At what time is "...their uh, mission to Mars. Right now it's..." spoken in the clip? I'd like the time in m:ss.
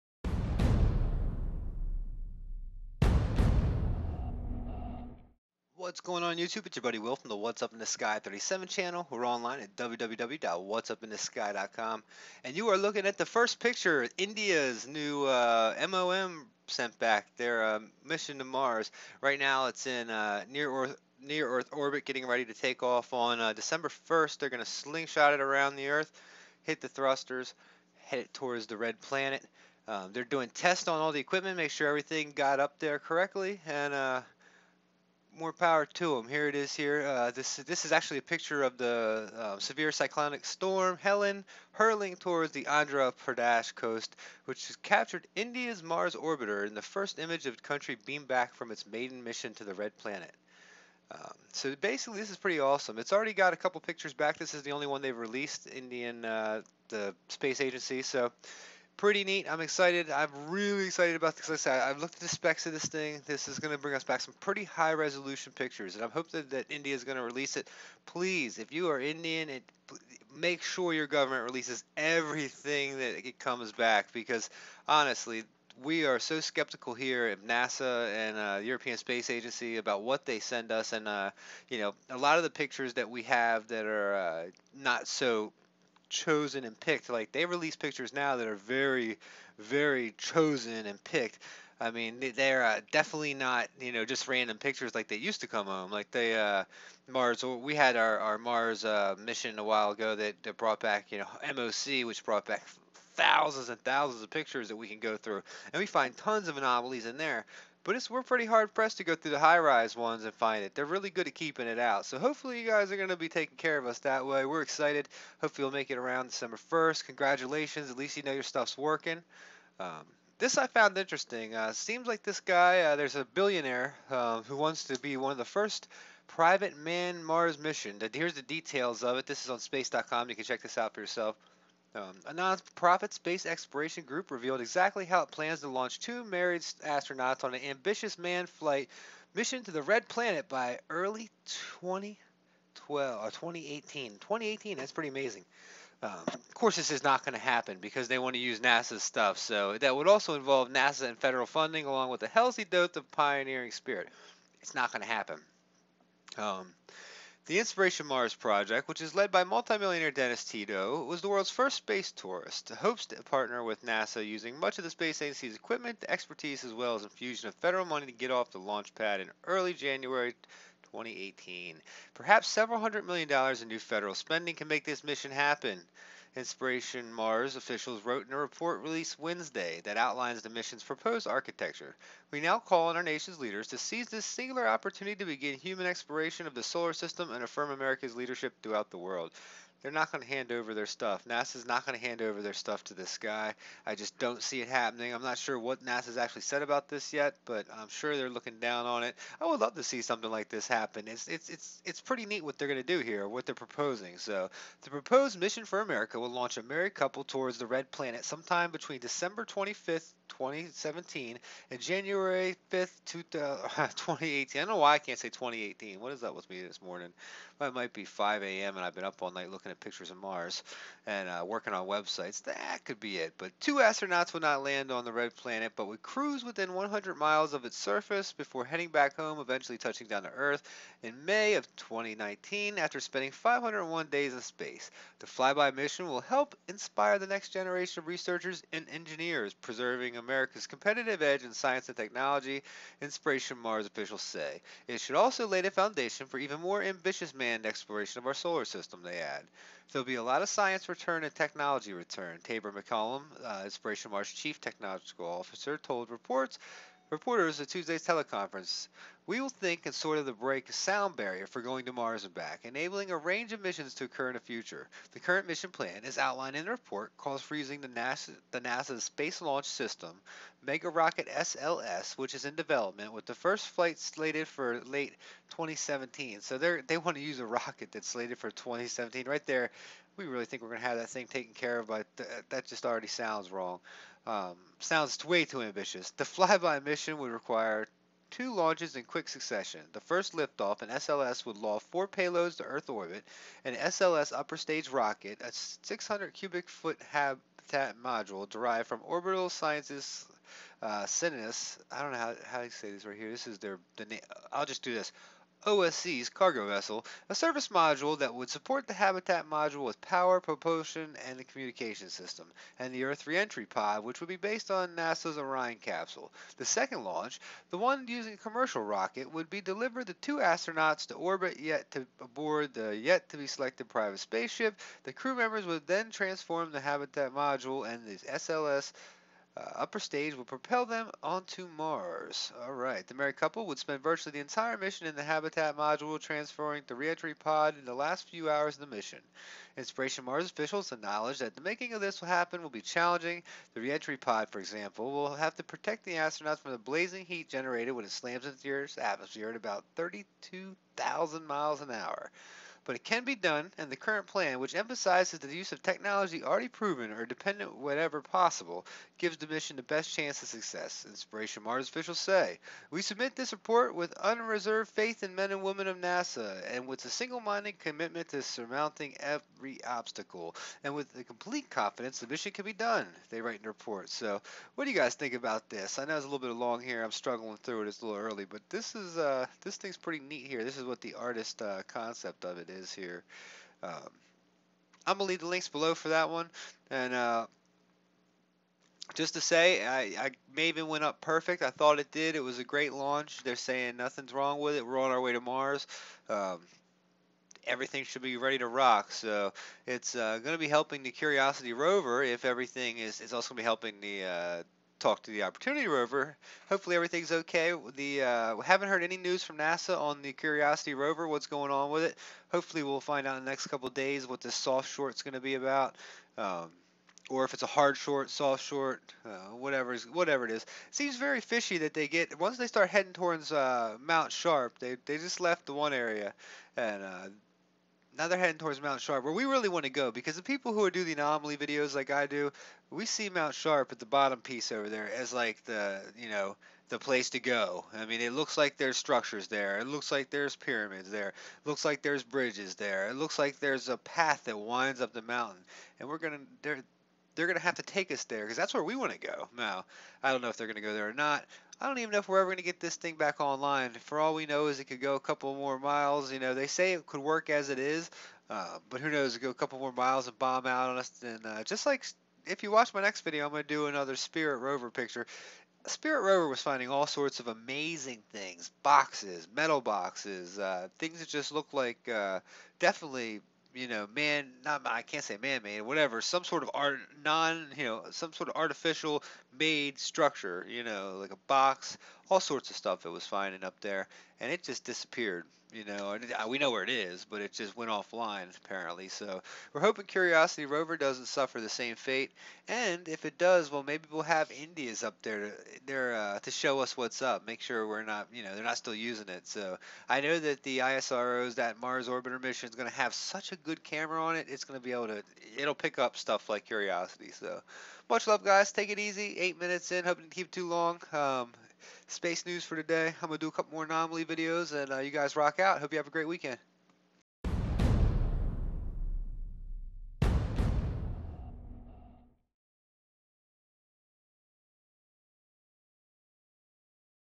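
0:17.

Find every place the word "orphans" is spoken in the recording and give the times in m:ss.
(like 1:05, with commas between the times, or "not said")
not said.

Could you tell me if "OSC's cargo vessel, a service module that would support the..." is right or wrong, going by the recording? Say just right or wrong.
right.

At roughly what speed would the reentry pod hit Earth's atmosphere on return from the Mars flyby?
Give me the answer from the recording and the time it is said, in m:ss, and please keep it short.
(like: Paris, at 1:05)
32,000 miles an hour, at 5:49.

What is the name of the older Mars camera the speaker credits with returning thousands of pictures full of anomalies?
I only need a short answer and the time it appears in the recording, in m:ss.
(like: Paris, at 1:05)
MOC, at 1:41.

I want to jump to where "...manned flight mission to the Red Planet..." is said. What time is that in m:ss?
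2:18.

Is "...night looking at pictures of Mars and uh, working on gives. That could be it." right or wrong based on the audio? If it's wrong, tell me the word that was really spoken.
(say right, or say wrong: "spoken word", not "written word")
wrong: "websites", not "gives".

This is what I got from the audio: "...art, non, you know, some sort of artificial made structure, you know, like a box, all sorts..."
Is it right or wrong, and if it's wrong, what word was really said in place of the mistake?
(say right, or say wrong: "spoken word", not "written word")
right.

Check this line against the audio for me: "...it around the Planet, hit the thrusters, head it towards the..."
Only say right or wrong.
wrong.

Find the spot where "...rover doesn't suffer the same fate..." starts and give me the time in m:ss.
8:10.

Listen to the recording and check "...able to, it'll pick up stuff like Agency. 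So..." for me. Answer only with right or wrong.
wrong.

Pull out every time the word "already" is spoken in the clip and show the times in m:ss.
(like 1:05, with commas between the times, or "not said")
0:53, 4:42, 5:56.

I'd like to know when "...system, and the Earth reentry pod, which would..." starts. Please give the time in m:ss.
5:12.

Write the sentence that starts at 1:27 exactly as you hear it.
Like they release pictures now that are very, very chosen and picked.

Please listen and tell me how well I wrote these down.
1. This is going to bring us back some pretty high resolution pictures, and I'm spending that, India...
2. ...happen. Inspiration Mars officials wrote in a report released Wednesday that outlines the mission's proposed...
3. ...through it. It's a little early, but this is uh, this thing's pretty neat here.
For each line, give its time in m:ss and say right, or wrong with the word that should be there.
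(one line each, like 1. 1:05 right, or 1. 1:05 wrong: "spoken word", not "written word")
1. 1:03 wrong: "hoping", not "spending"
2. 2:55 right
3. 6:17 right.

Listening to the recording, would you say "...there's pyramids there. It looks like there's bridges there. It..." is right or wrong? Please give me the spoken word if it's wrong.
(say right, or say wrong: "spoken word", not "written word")
right.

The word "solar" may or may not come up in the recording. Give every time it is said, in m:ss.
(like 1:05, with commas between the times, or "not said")
3:06, 4:08.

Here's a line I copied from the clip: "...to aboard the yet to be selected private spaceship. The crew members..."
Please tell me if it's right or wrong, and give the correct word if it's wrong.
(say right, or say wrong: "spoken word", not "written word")
right.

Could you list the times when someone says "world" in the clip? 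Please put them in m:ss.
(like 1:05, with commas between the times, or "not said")
2:41, 3:08.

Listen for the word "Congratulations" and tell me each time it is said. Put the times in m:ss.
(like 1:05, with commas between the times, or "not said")
1:57.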